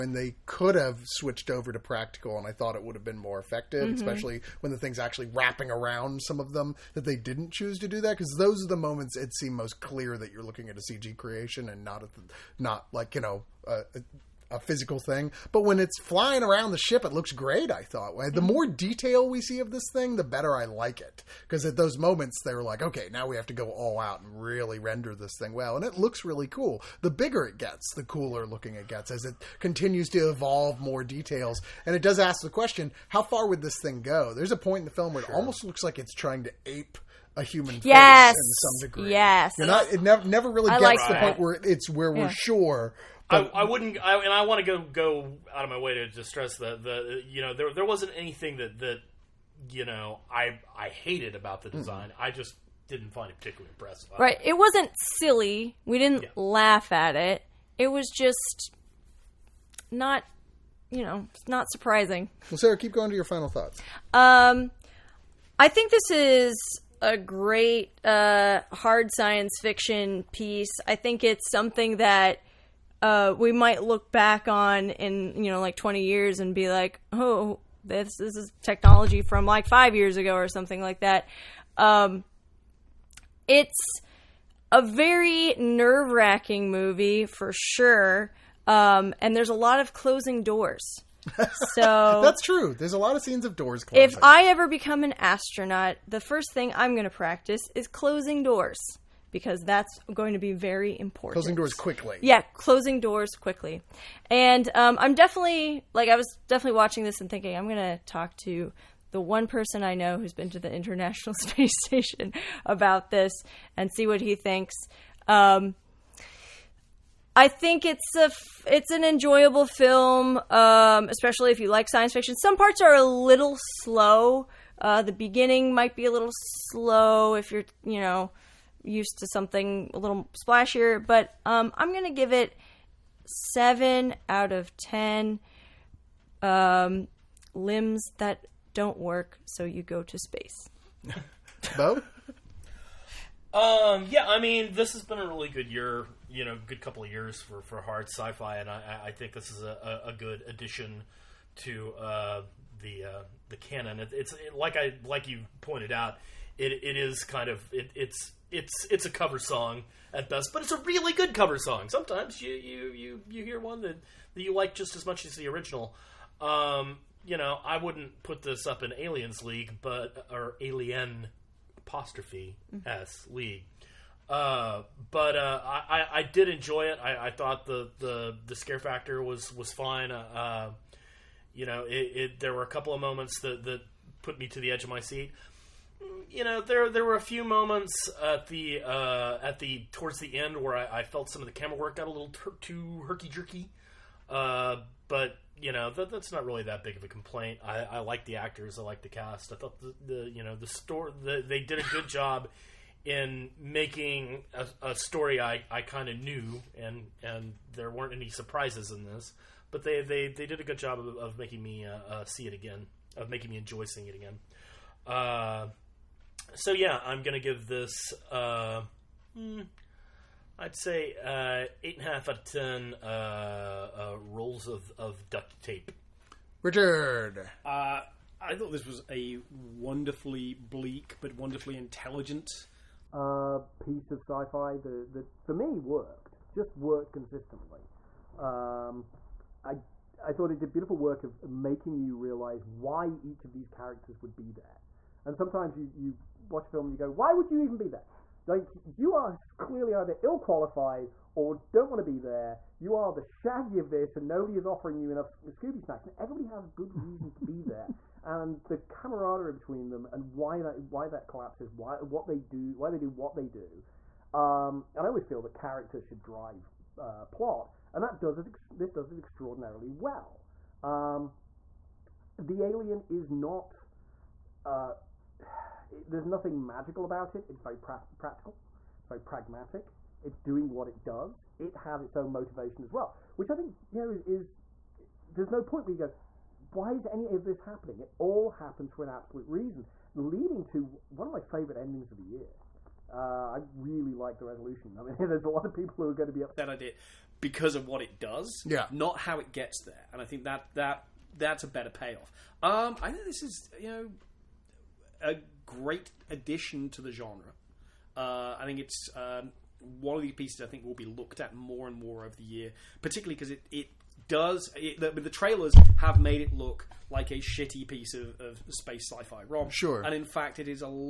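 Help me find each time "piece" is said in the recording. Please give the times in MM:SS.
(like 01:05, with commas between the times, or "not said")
01:10, 03:53, 05:10, 05:17.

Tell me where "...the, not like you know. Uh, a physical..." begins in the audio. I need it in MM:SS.
00:12.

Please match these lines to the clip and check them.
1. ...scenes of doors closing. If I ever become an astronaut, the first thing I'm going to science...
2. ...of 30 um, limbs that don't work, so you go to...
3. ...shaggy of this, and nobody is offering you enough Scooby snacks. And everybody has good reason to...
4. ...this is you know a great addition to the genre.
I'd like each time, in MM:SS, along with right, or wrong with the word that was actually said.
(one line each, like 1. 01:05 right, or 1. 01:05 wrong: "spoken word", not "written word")
1. 01:33 wrong: "practice", not "science"
2. 02:14 wrong: "10", not "30"
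3. 04:13 right
4. 05:03 right.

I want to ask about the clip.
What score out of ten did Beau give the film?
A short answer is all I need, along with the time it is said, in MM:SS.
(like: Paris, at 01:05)
8.5, at 03:41.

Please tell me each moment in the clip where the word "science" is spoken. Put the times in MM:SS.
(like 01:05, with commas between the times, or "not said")
01:09, 02:01.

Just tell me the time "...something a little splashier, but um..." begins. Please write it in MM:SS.
02:09.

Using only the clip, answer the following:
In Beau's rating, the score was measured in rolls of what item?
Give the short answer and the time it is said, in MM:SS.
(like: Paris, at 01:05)
Duct tape, at 03:45.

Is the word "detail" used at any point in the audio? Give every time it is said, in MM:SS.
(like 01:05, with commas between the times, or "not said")
00:18, 00:31.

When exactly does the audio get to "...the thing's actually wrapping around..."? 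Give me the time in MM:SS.
00:04.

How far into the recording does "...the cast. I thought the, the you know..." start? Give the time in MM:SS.
03:19.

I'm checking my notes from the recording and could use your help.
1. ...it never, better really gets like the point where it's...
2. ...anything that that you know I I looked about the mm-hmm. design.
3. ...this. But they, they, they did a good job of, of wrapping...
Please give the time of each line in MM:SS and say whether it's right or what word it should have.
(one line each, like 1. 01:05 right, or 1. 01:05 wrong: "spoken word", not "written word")
1. 00:39 wrong: "never", not "better"
2. 00:48 wrong: "hated", not "looked"
3. 03:29 wrong: "making", not "wrapping".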